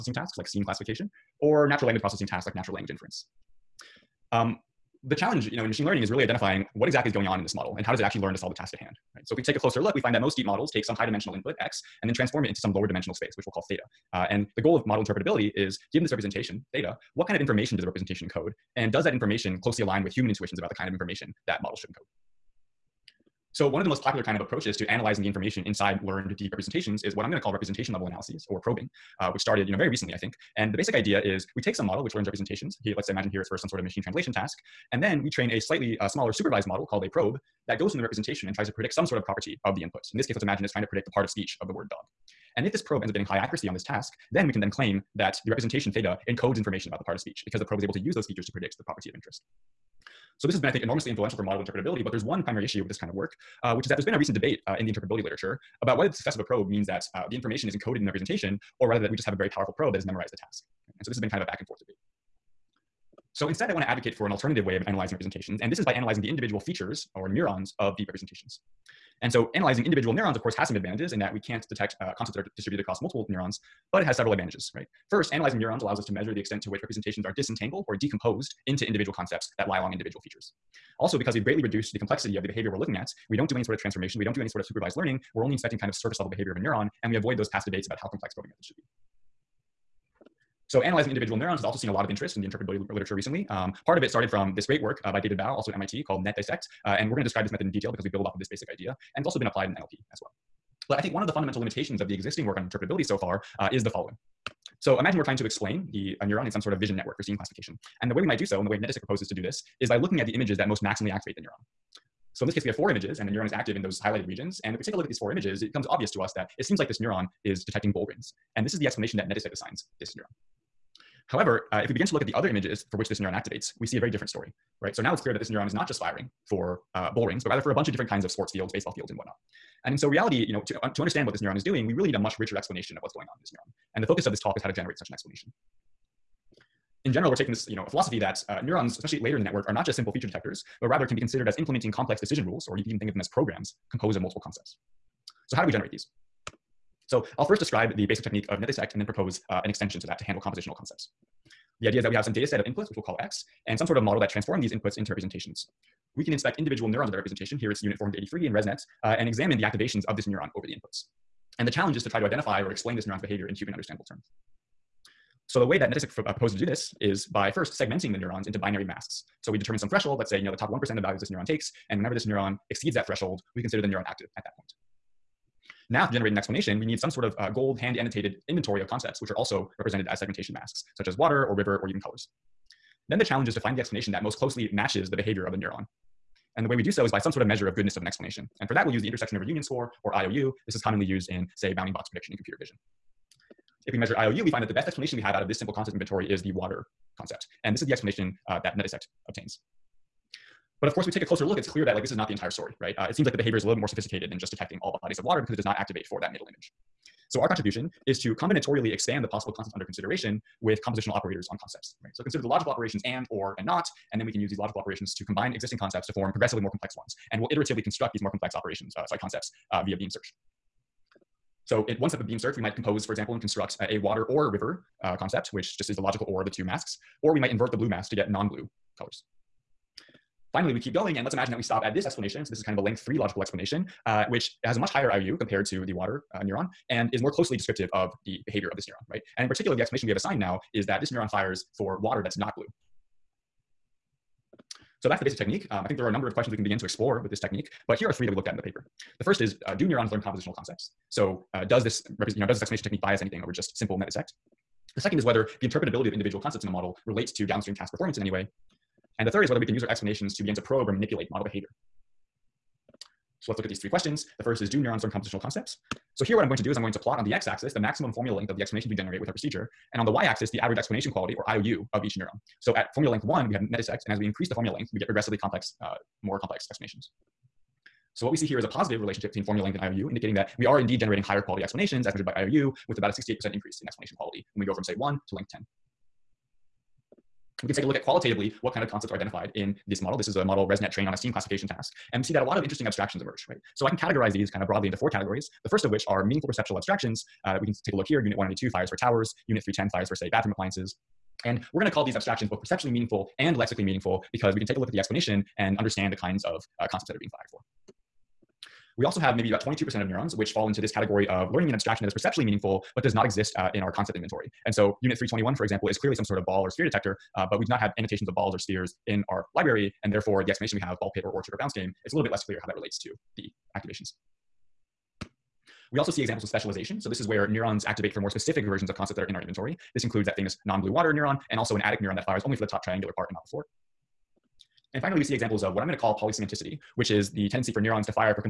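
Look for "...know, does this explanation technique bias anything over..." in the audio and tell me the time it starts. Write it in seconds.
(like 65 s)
252 s.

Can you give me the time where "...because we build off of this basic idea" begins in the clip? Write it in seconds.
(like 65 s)
97 s.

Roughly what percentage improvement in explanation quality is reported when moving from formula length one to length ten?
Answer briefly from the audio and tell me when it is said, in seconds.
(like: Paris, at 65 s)
68%, at 283 s.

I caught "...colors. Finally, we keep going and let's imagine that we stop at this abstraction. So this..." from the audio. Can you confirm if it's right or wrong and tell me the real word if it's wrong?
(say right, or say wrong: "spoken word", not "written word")
wrong: "explanation", not "abstraction".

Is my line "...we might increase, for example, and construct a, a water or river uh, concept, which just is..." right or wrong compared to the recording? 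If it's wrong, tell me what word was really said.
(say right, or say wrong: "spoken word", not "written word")
wrong: "compose", not "increase".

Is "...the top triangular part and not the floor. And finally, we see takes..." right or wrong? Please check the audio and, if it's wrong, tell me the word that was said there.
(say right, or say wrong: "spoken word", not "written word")
wrong: "examples", not "takes".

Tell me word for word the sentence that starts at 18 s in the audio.
And does that information closely align with human intuitions about the kind of information that model should encode?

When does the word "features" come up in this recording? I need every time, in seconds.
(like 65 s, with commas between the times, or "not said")
48 s, 66 s, 80 s, 140 s.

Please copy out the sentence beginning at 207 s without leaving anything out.
So our contribution is to combinatorially expand the possible concepts under consideration with compositional operators on concepts, right?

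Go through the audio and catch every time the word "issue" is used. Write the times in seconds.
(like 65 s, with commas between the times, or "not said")
52 s.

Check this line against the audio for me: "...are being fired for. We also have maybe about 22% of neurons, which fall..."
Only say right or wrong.
right.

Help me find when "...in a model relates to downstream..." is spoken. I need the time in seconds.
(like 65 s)
256 s.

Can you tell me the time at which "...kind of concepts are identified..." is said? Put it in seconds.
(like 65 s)
288 s.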